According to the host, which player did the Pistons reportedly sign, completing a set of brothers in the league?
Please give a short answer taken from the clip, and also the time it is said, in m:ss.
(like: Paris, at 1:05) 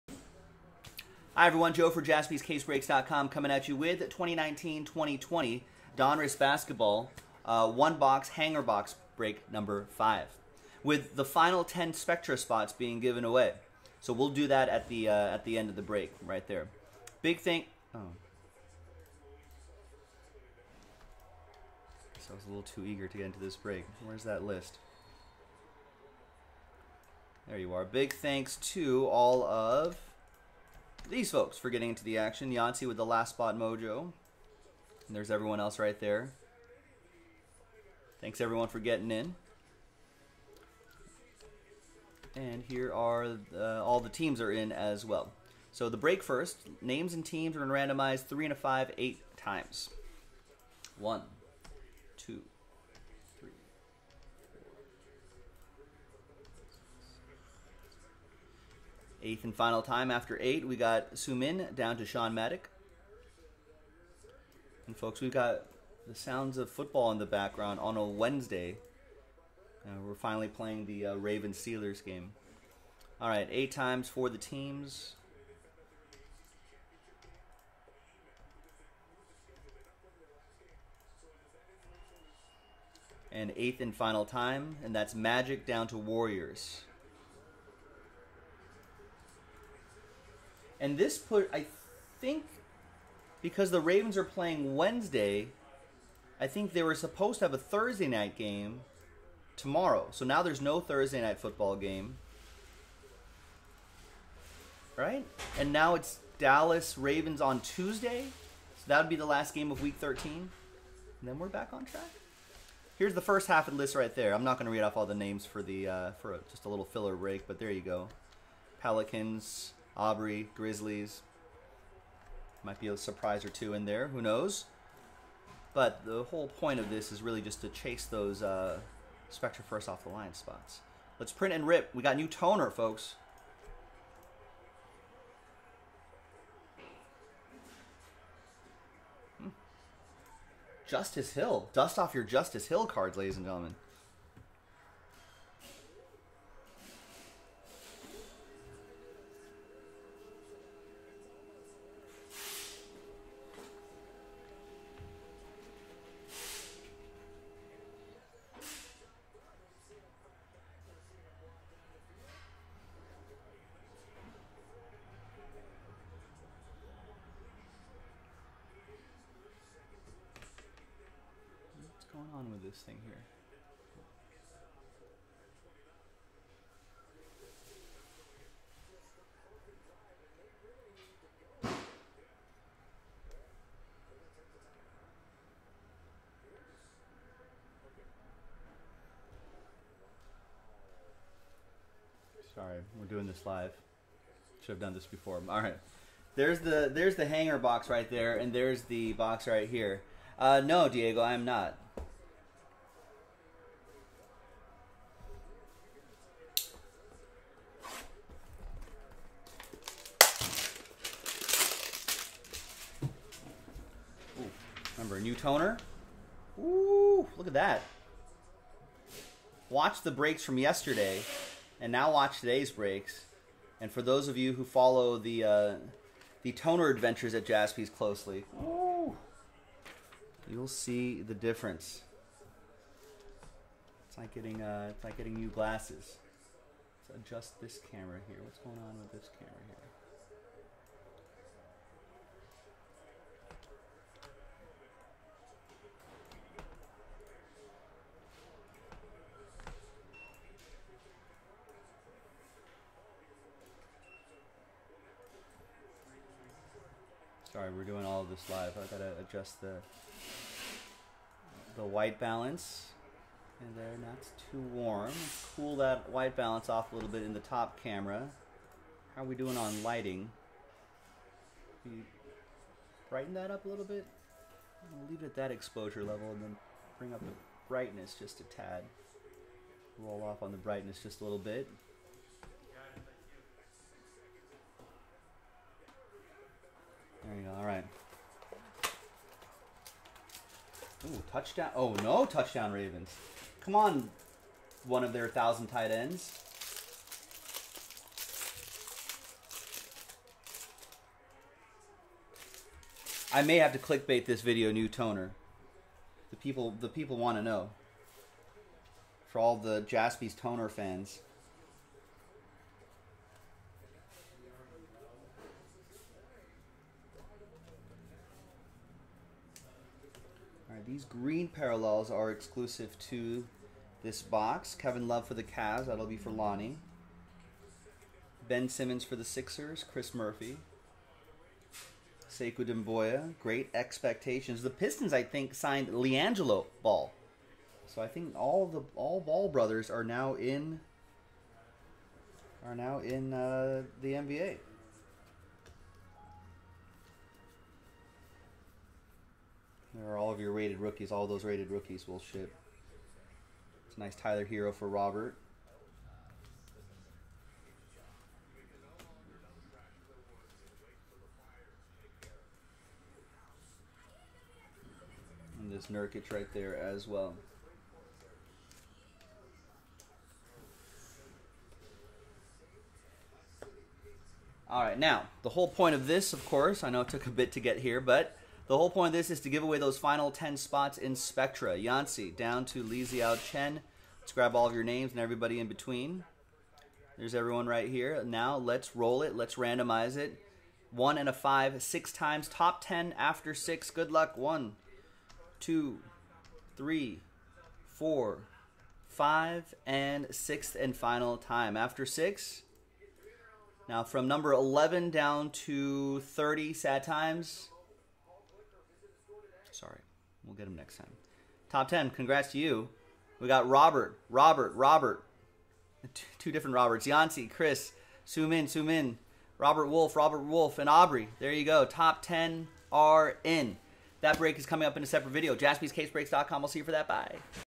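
LiAngelo Ball, at 5:35.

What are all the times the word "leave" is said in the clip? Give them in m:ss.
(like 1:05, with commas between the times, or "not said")
4:35.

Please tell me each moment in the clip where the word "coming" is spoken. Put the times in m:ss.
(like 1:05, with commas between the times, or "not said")
0:03, 7:04.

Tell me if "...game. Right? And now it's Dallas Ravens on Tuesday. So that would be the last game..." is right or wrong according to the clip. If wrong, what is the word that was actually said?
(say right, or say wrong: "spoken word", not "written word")
right.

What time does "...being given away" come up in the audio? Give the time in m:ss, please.
0:12.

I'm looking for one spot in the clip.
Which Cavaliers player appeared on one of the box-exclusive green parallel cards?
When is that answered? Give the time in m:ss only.
5:24.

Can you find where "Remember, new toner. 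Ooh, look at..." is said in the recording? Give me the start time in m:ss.
3:34.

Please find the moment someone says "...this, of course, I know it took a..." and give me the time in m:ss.
6:16.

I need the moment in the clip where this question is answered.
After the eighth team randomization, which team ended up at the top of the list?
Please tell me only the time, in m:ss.
1:25.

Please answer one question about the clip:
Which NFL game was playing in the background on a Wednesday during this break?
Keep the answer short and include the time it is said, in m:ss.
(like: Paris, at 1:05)
Ravens Steelers, at 1:11.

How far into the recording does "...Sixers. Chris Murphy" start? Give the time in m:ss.
5:29.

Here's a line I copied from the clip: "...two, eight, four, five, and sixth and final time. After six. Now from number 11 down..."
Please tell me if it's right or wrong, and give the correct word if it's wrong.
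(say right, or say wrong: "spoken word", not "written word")
wrong: "three", not "eight".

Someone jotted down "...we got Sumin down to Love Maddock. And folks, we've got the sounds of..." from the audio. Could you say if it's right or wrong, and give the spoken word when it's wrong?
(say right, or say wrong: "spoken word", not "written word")
wrong: "Sean", not "Love".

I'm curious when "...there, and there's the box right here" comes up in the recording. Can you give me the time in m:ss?
3:18.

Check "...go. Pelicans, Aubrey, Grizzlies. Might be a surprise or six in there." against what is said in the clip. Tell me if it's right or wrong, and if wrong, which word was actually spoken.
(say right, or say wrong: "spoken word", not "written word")
wrong: "two", not "six".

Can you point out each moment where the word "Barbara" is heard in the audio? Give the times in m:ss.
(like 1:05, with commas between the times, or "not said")
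not said.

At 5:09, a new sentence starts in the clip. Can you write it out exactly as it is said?
For all the Jaspy's toner fans.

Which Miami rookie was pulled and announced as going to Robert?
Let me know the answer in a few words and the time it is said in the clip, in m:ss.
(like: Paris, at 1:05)
Tyler Herro, at 5:54.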